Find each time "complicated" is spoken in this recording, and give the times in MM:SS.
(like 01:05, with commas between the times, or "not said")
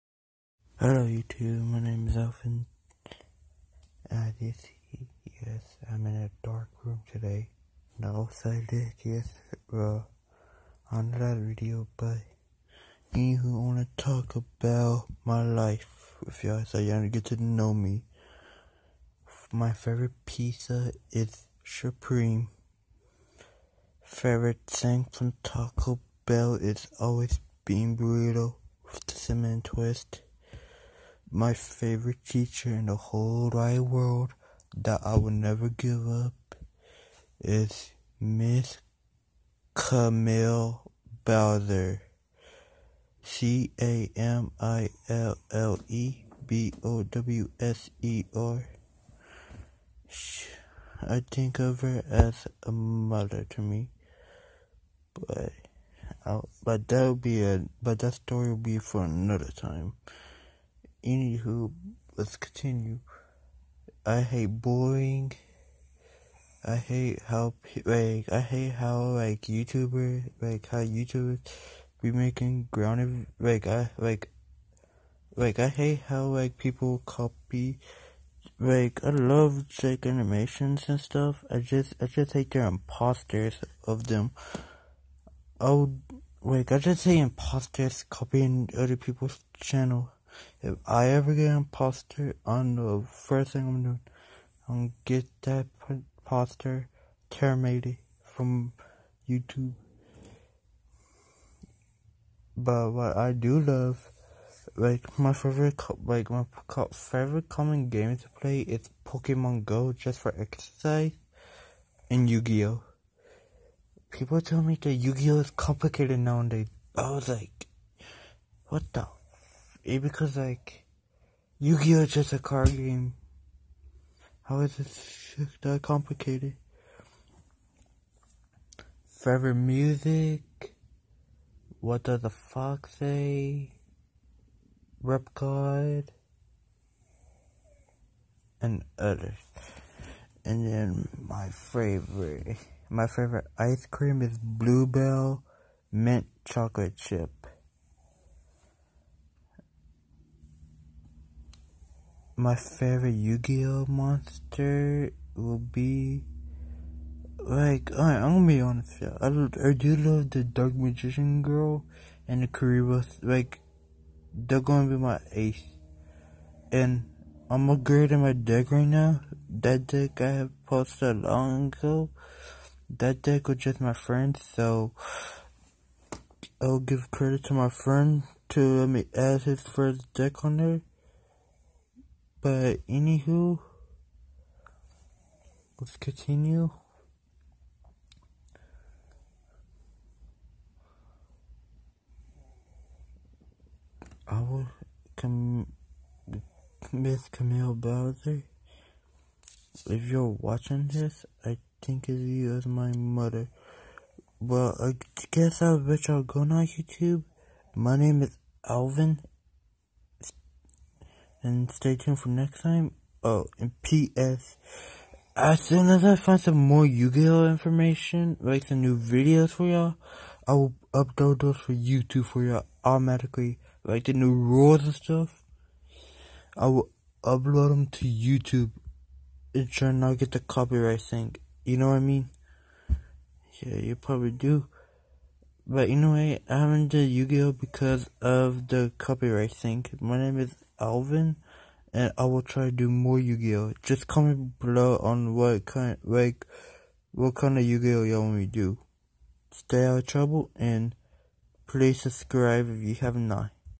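01:55, 02:05.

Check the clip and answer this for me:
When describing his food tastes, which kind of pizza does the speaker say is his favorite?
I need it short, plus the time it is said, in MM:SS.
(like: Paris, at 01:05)
Supreme, at 00:21.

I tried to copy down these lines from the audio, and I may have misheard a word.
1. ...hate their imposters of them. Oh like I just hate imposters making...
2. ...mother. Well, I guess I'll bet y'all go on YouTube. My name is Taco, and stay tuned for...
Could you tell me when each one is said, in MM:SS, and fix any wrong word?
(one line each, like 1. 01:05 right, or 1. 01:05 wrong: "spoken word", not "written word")
1. 01:22 wrong: "copying", not "making"
2. 03:22 wrong: "Alvin", not "Taco".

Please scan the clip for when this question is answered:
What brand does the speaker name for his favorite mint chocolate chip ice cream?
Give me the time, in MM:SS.
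02:24.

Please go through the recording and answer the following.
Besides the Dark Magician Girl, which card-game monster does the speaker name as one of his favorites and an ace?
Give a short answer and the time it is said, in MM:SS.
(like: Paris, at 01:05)
Kuriboh, at 02:42.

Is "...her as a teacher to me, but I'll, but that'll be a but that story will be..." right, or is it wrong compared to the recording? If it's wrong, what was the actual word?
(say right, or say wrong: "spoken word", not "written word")
wrong: "mother", not "teacher".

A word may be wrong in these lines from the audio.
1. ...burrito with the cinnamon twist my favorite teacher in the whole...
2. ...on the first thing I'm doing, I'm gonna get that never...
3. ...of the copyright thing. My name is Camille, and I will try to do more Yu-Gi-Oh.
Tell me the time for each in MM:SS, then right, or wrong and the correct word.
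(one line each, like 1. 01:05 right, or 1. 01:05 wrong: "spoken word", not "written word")
1. 00:27 right
2. 01:32 wrong: "imposter", not "never"
3. 03:58 wrong: "Alvin", not "Camille".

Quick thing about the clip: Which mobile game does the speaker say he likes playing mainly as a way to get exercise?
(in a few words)
Pokemon Go.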